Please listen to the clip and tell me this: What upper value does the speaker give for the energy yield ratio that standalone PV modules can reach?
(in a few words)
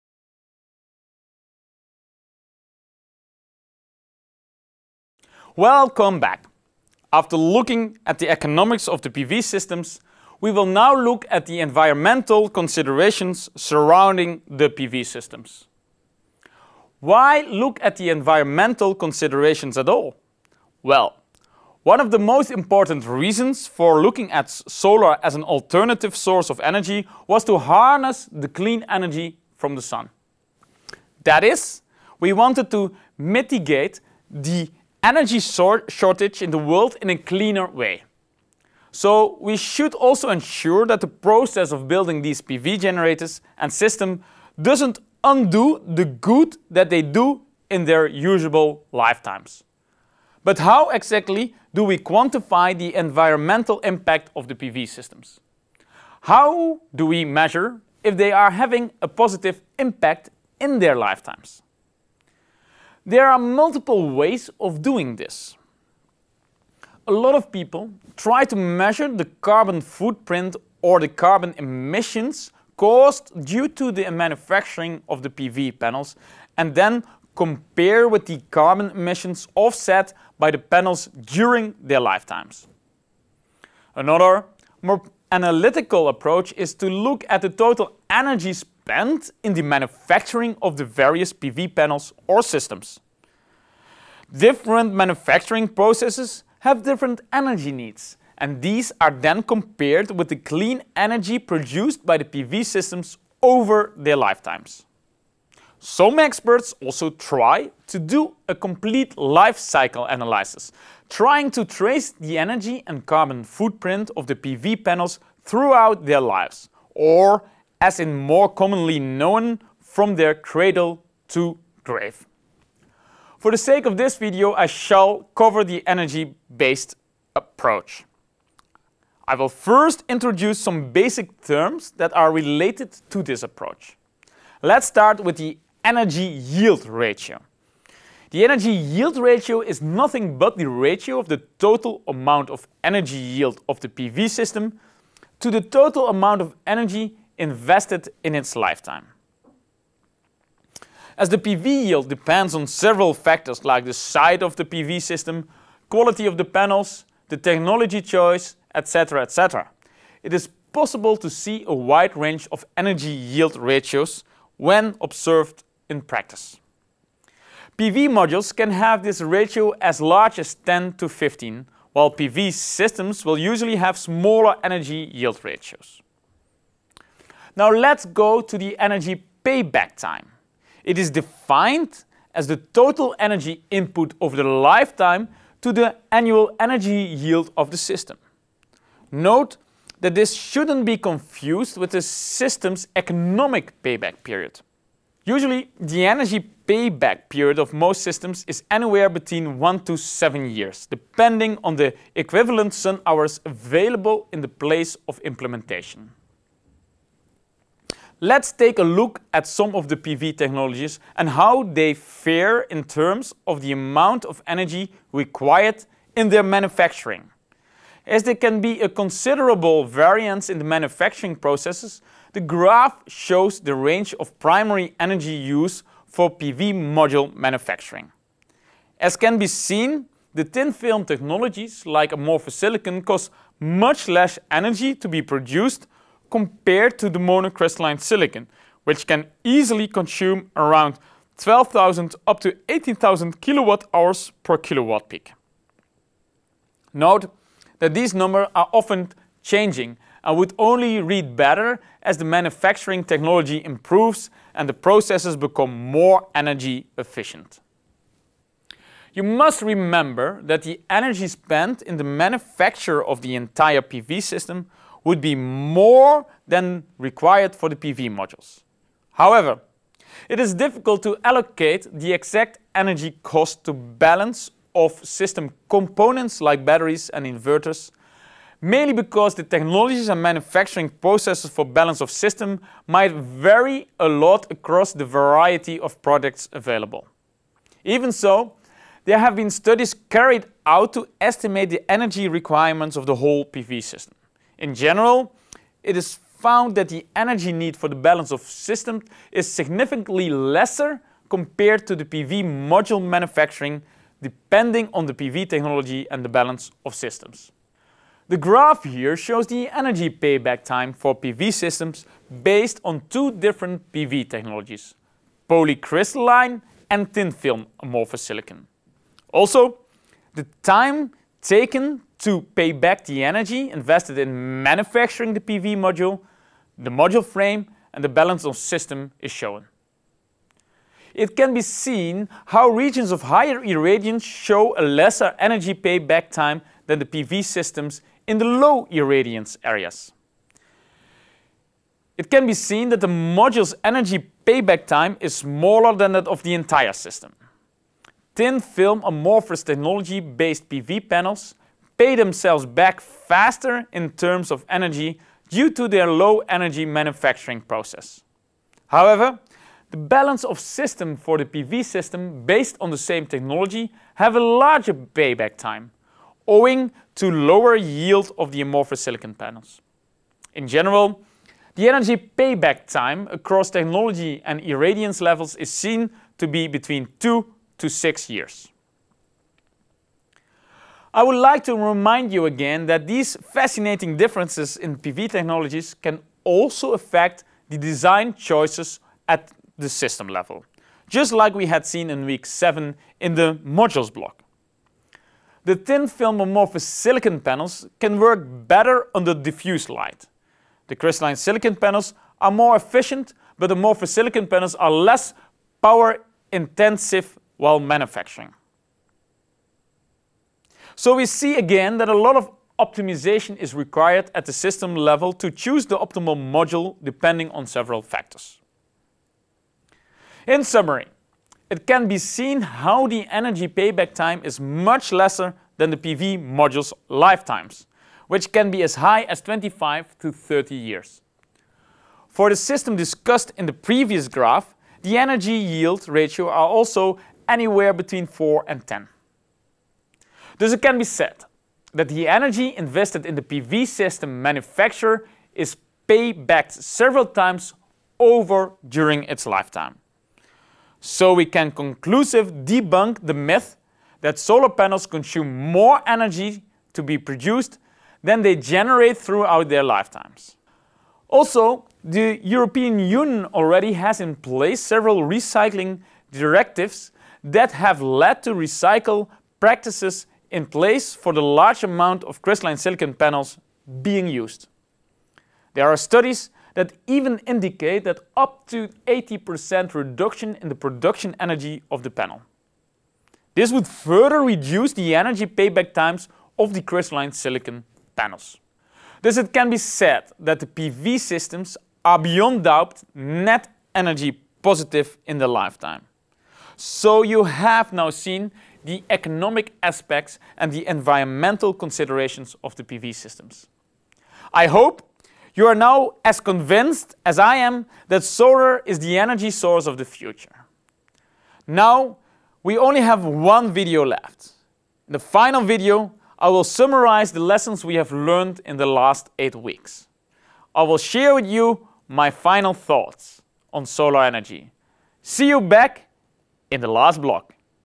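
15.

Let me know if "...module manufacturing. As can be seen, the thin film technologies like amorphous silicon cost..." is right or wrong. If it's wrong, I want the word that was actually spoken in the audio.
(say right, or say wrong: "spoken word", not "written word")
right.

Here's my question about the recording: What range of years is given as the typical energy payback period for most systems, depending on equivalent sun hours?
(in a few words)
1 to 7 years.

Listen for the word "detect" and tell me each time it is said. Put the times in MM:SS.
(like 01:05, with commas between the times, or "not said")
not said.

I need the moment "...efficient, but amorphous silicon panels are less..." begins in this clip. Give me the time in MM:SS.
06:42.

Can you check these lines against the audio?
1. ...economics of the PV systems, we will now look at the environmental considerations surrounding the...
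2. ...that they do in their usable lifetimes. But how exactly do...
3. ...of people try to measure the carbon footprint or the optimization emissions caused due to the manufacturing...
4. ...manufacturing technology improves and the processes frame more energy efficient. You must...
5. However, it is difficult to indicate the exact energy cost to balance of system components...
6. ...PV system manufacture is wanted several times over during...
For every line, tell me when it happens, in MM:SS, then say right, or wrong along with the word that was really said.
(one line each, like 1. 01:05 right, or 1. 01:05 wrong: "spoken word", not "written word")
1. 00:08 right
2. 00:46 right
3. 01:07 wrong: "carbon", not "optimization"
4. 04:12 wrong: "become", not "frame"
5. 04:29 wrong: "allocate", not "indicate"
6. 07:23 wrong: "paybacked", not "wanted".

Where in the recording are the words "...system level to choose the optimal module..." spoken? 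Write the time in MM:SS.
06:54.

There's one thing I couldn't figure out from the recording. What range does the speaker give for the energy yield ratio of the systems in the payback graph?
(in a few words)
4 and 10.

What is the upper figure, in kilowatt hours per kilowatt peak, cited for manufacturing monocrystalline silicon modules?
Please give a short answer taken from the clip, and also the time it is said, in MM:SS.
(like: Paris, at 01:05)
18,000, at 04:02.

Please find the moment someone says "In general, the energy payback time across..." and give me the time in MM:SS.
06:10.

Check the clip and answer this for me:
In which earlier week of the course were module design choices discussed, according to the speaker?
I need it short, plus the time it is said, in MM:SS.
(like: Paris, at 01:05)
week 7, at 06:32.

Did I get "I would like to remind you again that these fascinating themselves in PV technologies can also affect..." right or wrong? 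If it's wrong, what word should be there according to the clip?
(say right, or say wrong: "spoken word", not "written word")
wrong: "differences", not "themselves".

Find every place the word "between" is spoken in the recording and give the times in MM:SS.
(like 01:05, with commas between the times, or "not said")
03:19, 06:16, 07:17.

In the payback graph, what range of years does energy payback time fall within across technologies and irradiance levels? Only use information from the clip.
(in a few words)
2 to 6 years.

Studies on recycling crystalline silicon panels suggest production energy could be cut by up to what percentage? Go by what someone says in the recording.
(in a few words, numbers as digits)
80%.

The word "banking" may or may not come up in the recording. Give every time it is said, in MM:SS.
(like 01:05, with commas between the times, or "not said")
not said.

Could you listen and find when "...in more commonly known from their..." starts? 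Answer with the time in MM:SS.
01:57.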